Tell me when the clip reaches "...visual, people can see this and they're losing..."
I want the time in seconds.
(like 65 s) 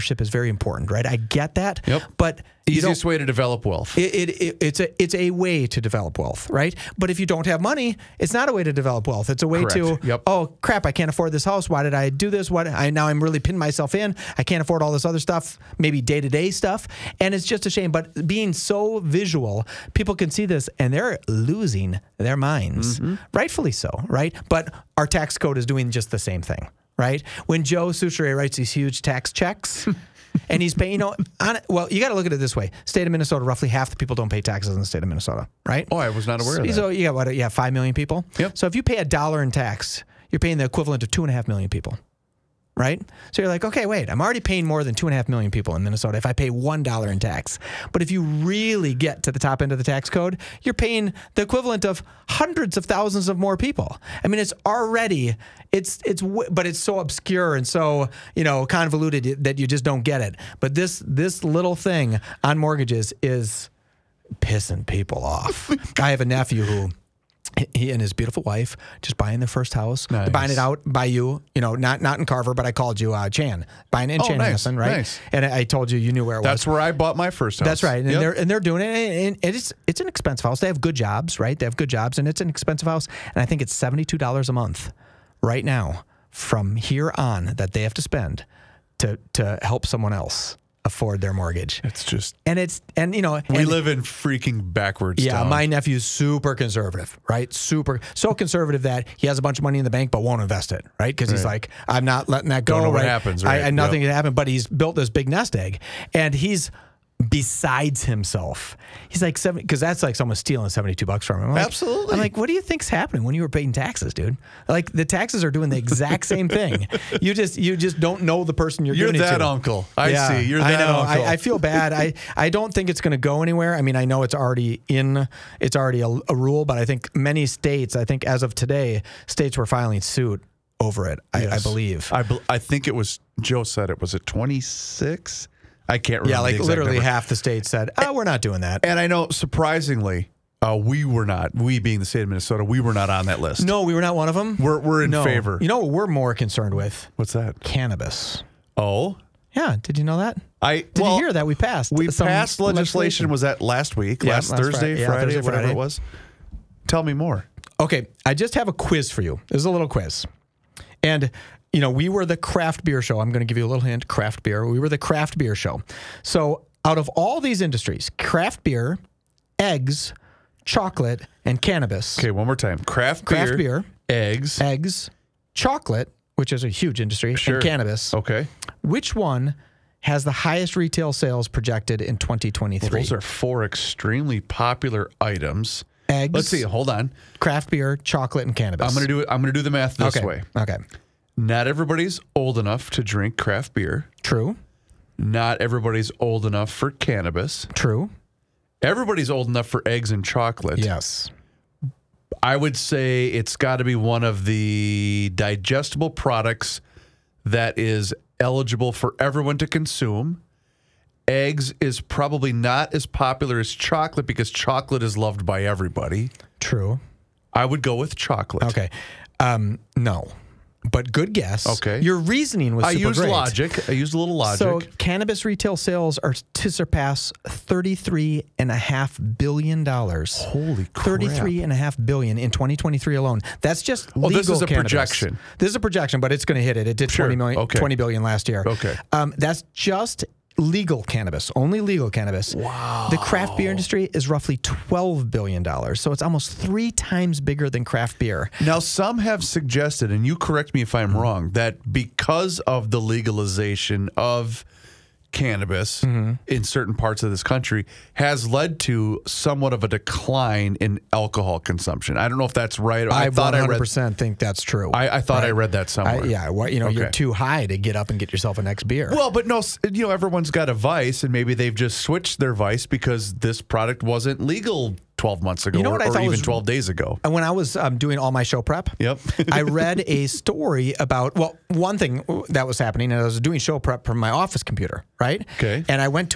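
18 s.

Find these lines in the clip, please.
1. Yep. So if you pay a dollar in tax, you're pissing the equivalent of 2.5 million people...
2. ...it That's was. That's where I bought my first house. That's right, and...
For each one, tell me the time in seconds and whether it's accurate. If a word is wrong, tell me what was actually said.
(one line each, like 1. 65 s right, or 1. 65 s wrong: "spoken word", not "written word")
1. 38 s wrong: "paying", not "pissing"
2. 76 s right.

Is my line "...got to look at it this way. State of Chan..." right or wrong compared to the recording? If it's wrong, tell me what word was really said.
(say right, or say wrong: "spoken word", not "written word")
wrong: "Minnesota", not "Chan".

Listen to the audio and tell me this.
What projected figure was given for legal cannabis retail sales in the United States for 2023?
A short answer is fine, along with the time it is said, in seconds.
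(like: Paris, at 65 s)
$33.5 billion, at 227 s.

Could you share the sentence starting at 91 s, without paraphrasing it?
It's just and it's and you know we and, live in freaking backwards.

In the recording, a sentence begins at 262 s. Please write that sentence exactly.
I don't know if that's right.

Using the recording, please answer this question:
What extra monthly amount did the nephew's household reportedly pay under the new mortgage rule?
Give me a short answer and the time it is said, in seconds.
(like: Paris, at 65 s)
$72, at 83 s.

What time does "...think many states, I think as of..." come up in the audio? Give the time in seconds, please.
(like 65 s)
126 s.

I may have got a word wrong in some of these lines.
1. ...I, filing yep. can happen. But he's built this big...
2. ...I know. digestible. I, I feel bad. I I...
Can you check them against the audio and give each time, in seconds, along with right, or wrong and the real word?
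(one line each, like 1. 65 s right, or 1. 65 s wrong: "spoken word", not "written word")
1. 103 s wrong: "nothing", not "filing"
2. 120 s wrong: "uncle", not "digestible".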